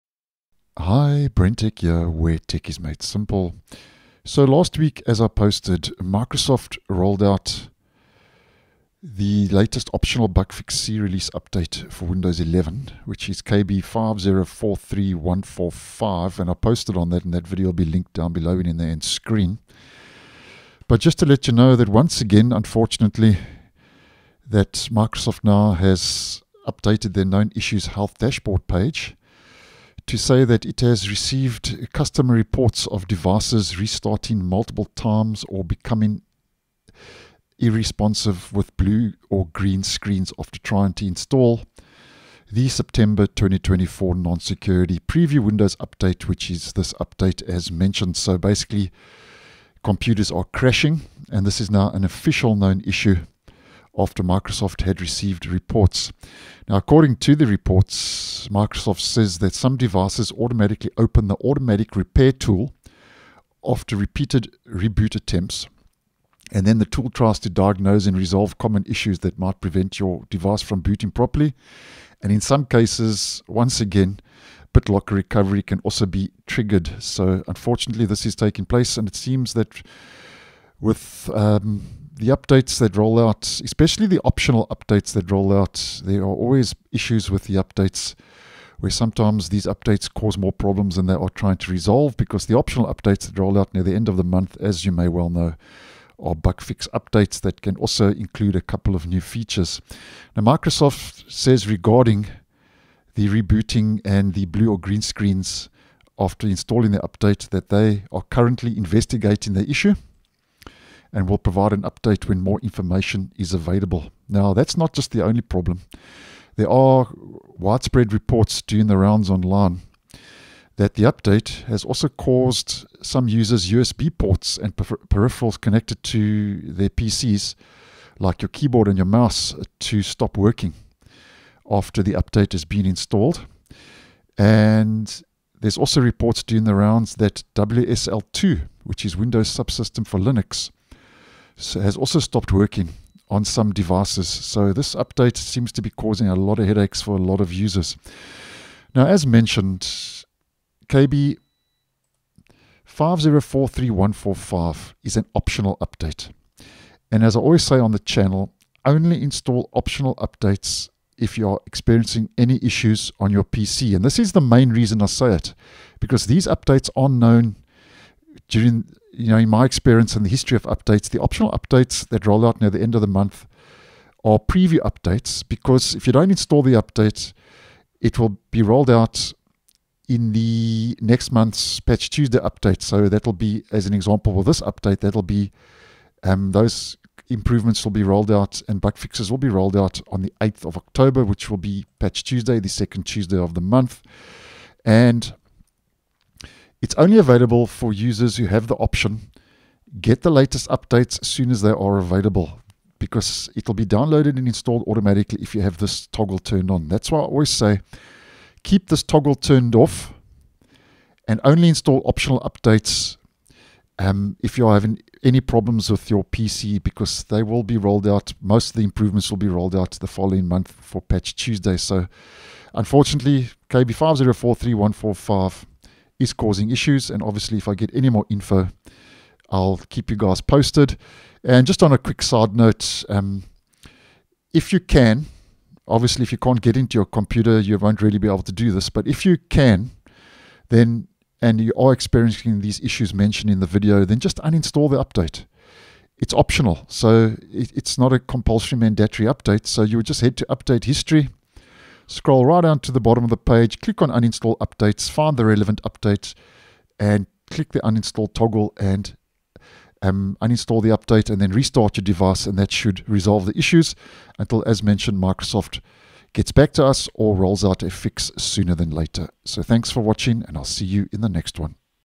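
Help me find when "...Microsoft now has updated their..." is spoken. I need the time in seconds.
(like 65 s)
24 s.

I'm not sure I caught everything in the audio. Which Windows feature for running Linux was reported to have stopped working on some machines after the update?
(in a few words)
WSL2.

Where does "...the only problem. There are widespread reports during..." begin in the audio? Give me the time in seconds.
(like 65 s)
115 s.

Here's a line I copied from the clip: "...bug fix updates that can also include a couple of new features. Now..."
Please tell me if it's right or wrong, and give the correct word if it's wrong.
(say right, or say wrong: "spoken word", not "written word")
right.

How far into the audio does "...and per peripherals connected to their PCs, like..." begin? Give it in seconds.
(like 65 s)
124 s.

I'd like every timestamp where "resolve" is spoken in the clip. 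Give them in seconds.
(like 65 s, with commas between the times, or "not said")
68 s, 91 s, 263 s.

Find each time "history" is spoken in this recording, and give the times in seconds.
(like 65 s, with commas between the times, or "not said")
170 s, 250 s.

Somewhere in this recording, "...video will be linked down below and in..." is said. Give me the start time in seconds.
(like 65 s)
17 s.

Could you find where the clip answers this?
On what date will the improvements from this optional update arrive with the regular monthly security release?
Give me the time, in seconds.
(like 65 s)
190 s.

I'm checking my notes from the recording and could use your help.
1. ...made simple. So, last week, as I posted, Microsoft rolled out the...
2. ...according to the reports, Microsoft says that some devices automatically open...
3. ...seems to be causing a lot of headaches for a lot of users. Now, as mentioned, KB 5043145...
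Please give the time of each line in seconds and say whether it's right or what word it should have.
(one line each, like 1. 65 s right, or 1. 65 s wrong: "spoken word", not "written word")
1. 2 s right
2. 56 s right
3. 145 s right.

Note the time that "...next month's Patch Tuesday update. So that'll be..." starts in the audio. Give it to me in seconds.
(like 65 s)
181 s.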